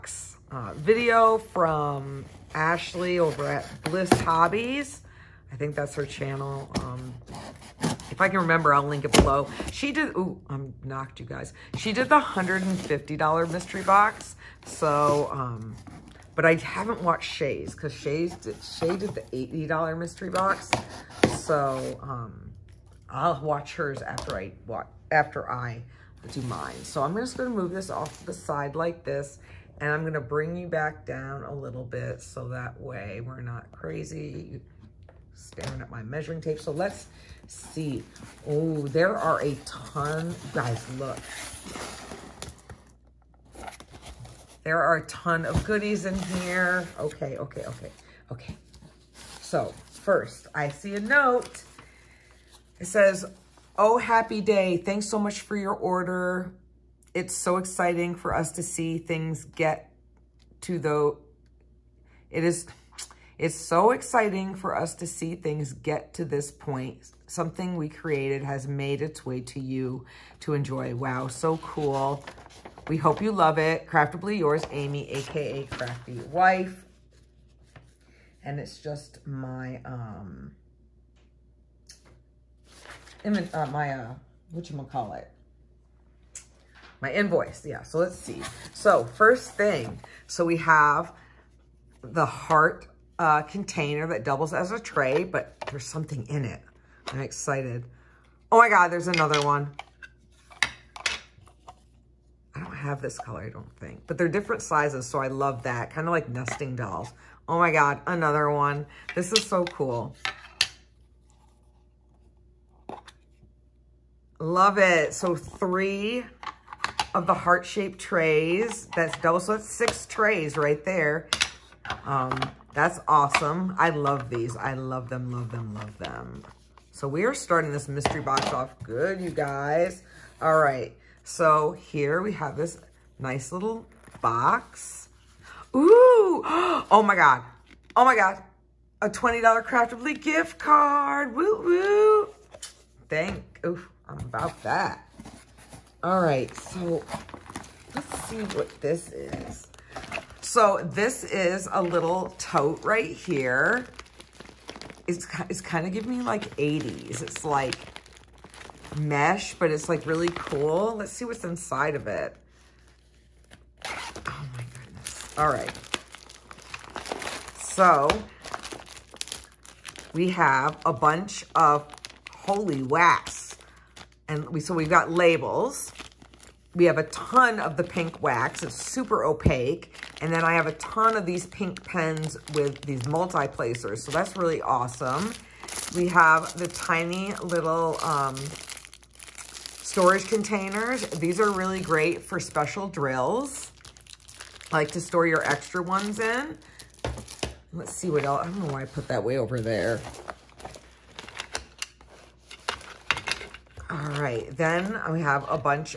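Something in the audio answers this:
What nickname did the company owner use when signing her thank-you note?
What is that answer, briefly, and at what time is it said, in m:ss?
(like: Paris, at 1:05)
Crafty Wife, at 1:15.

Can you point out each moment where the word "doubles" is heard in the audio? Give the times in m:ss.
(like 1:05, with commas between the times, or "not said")
1:34, 1:59.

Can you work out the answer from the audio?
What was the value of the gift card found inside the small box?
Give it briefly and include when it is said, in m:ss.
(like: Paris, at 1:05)
$20, at 2:19.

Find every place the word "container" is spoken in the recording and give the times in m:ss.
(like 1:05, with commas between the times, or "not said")
1:33, 3:10.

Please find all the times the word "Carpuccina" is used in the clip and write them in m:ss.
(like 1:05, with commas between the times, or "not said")
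not said.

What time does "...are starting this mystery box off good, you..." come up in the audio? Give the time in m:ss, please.
2:07.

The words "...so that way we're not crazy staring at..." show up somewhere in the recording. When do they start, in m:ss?
0:32.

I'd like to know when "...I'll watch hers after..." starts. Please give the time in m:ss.
0:23.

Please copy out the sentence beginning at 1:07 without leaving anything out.
Something we created has made its way to you to enjoy.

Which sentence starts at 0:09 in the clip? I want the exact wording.
She did, ooh, I'm knocked you guys.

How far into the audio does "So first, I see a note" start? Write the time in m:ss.
0:49.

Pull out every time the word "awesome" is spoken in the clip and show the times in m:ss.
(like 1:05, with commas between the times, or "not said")
2:03, 3:04.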